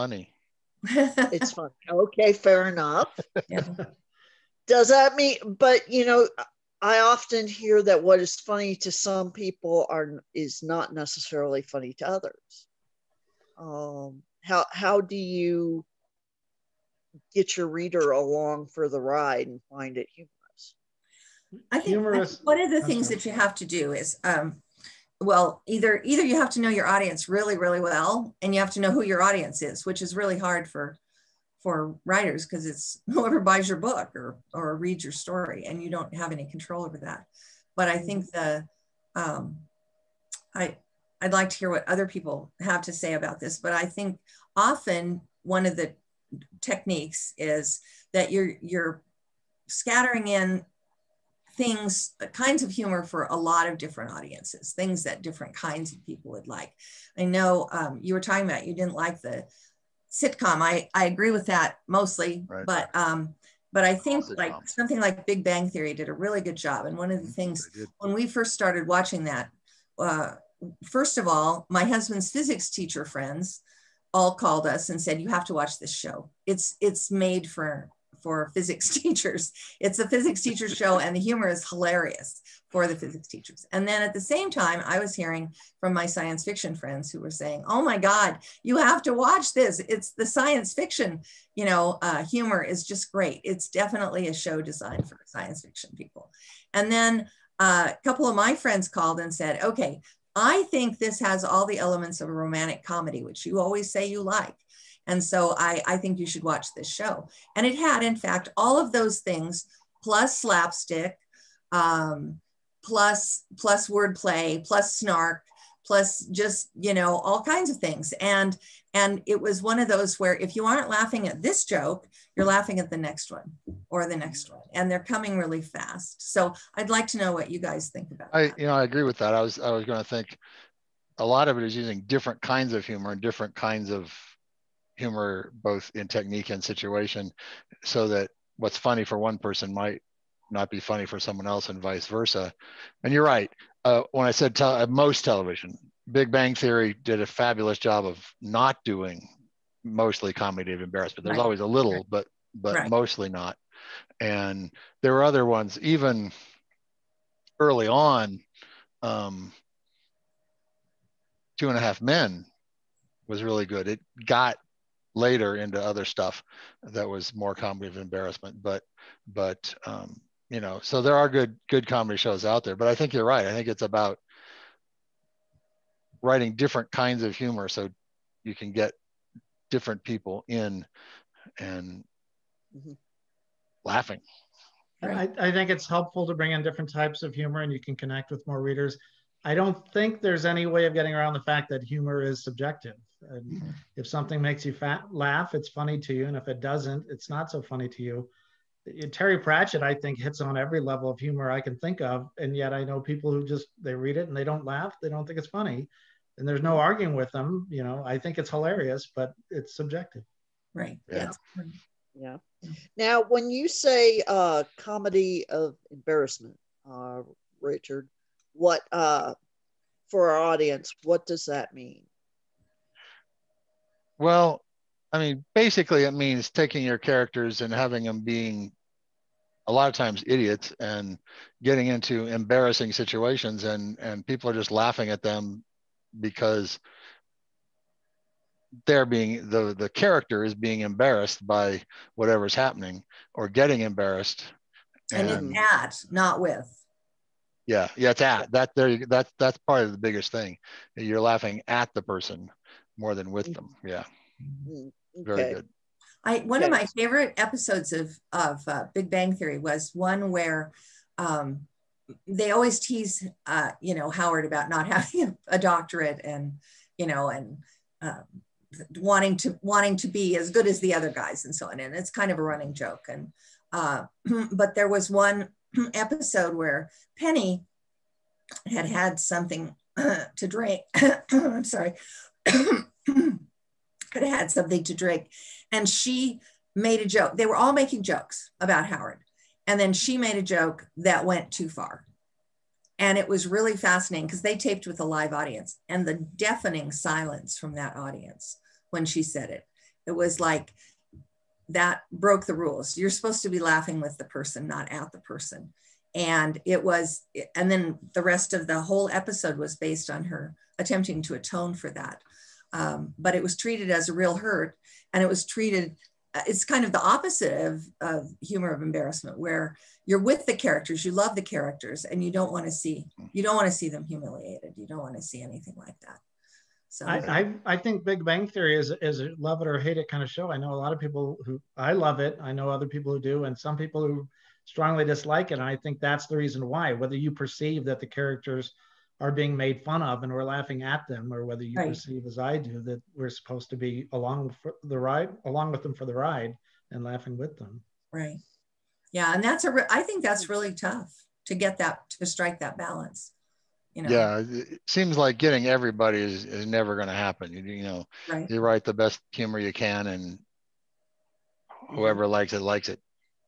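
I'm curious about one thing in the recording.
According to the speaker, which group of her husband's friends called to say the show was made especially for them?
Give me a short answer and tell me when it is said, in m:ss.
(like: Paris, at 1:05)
physics teachers, at 1:12.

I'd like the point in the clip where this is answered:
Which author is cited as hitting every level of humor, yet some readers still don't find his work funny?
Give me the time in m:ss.
3:19.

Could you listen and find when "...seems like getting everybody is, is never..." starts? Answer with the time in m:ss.
5:54.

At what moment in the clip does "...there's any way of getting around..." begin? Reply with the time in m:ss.
3:10.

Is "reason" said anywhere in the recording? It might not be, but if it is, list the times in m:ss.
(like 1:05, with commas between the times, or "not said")
5:36.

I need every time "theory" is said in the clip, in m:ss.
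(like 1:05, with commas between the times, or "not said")
1:05, 2:26, 4:19, 5:28.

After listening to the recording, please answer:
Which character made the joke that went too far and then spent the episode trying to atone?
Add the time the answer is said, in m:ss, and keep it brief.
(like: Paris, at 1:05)
Penny, at 4:37.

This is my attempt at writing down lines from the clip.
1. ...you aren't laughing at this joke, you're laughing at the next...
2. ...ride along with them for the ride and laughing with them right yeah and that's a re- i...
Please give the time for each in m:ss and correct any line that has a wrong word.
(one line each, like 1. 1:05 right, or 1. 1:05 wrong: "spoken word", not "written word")
1. 2:00 right
2. 5:44 right.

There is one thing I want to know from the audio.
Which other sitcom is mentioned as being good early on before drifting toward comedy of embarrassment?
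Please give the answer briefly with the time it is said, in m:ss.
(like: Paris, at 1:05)
Two and a Half Men, at 2:41.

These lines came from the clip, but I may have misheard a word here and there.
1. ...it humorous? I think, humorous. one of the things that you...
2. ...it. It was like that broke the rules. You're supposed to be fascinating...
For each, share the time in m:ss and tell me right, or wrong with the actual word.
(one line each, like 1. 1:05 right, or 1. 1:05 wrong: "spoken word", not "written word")
1. 0:19 right
2. 4:59 wrong: "laughing", not "fascinating".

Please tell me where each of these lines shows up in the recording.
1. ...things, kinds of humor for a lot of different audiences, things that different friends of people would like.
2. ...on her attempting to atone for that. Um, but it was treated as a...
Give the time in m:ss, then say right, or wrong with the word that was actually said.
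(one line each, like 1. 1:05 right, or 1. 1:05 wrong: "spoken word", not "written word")
1. 0:51 wrong: "kinds", not "friends"
2. 5:10 right.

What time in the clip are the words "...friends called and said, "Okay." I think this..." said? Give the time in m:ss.
1:38.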